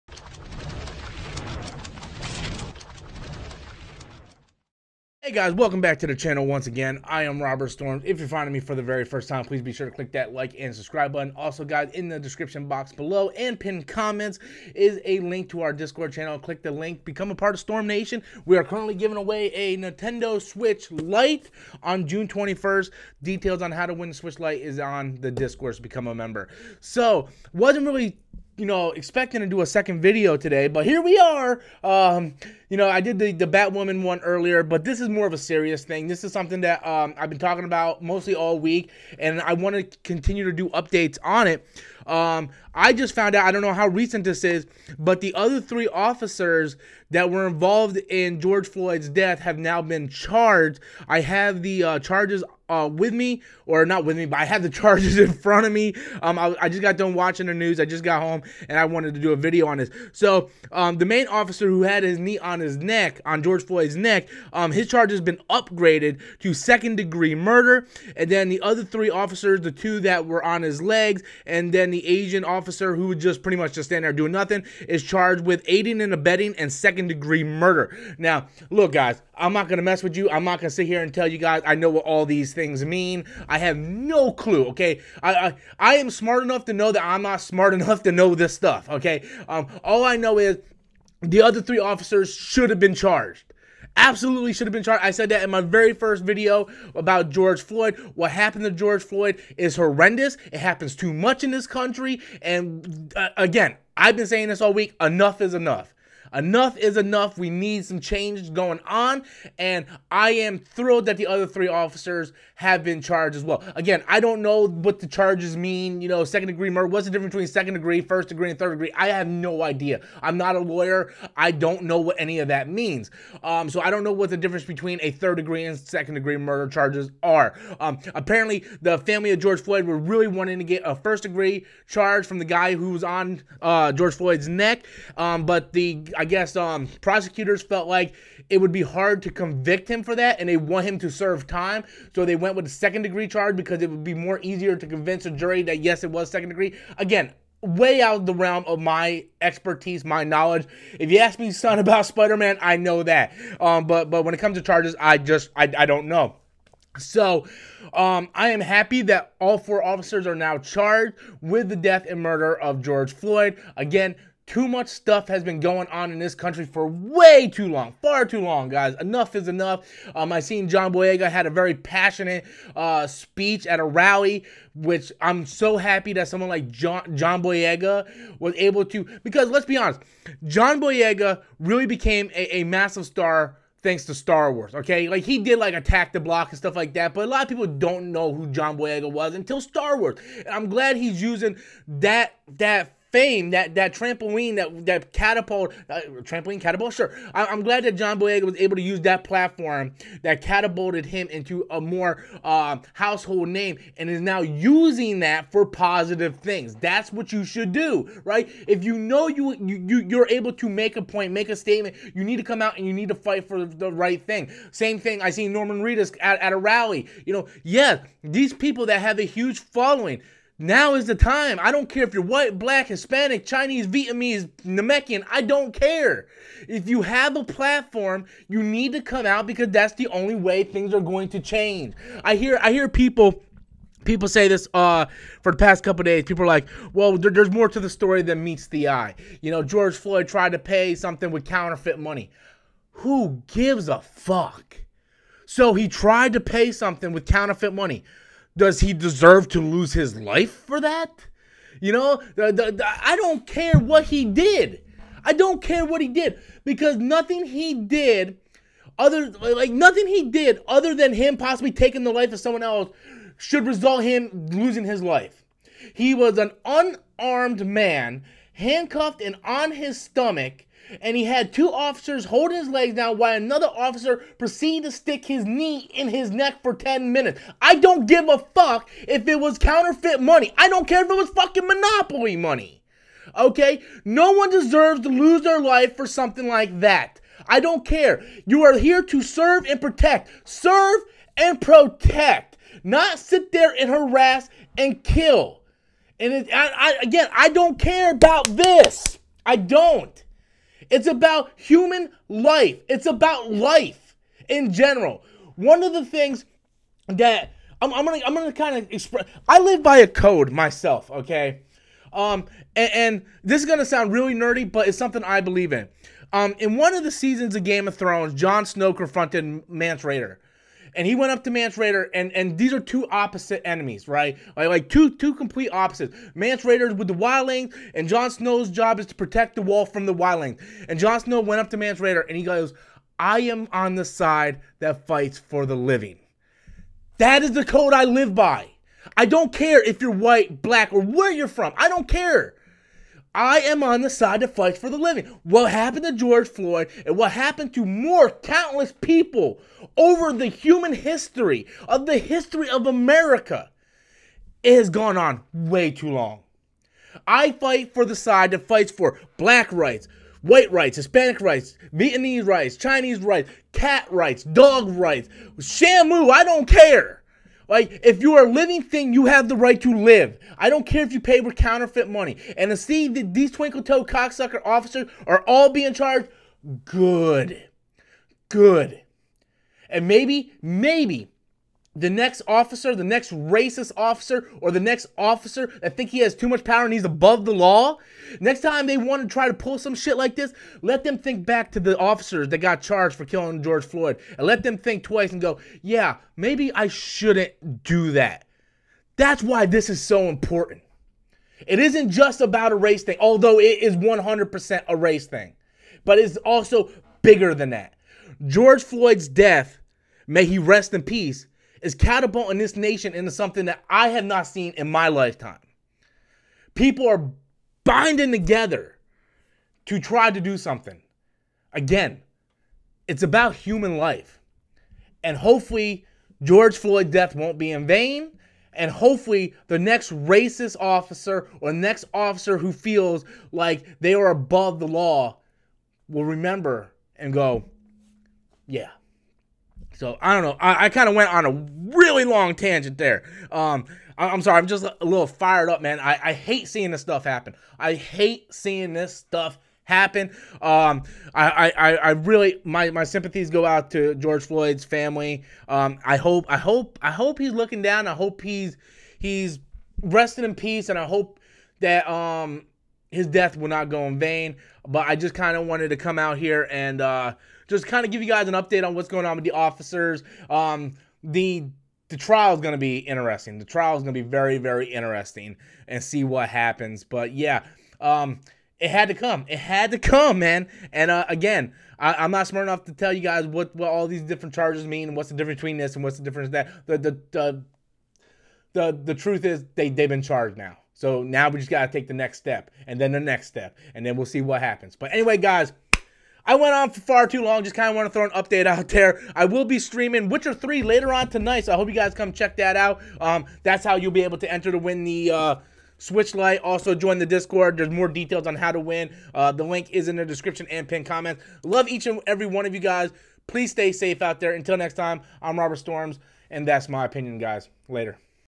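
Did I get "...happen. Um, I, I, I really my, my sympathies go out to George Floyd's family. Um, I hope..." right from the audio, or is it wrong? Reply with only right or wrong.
right.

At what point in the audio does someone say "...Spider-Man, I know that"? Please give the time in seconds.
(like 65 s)
152 s.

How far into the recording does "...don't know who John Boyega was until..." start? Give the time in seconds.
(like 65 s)
187 s.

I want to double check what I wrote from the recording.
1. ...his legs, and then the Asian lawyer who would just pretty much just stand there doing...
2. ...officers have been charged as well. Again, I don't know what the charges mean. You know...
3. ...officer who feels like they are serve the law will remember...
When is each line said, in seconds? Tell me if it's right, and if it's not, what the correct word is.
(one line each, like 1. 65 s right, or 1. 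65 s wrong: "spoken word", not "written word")
1. 70 s wrong: "officer", not "lawyer"
2. 111 s right
3. 432 s wrong: "above", not "serve".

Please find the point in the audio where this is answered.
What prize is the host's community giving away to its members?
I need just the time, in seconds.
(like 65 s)
19 s.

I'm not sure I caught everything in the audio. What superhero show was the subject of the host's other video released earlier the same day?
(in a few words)
Batwoman.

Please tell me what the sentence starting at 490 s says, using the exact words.
So now we just got to take the next step and then the next step and then we'll see what happens.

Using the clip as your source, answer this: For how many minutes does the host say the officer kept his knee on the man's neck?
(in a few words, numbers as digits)
10.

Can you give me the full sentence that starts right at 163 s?
Again, too much stuff has been going on in this country for way too long, far too long, guys.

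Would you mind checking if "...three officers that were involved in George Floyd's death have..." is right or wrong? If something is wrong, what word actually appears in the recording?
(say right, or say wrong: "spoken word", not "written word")
right.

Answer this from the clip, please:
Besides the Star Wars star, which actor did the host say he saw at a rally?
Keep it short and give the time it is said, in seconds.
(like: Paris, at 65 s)
Norman Reedus, at 215 s.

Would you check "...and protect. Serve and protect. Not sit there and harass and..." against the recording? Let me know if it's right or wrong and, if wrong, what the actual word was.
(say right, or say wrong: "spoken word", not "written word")
right.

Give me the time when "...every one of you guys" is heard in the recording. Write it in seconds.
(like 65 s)
512 s.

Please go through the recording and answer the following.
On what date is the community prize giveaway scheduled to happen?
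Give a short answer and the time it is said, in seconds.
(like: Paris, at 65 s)
June 21st, at 22 s.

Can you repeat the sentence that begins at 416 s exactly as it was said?
People are binding together to try to do something.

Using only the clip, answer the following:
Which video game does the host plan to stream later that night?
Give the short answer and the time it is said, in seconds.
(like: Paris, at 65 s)
Witcher 3, at 500 s.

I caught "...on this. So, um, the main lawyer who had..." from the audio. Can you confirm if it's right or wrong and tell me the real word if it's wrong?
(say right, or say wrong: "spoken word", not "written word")
wrong: "officer", not "lawyer".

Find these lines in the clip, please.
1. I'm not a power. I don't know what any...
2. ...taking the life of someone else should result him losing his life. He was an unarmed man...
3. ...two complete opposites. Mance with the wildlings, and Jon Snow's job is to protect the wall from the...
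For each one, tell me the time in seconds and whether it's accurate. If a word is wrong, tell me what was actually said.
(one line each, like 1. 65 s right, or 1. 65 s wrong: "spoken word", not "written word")
1. 120 s wrong: "lawyer", not "power"
2. 261 s right
3. 325 s right.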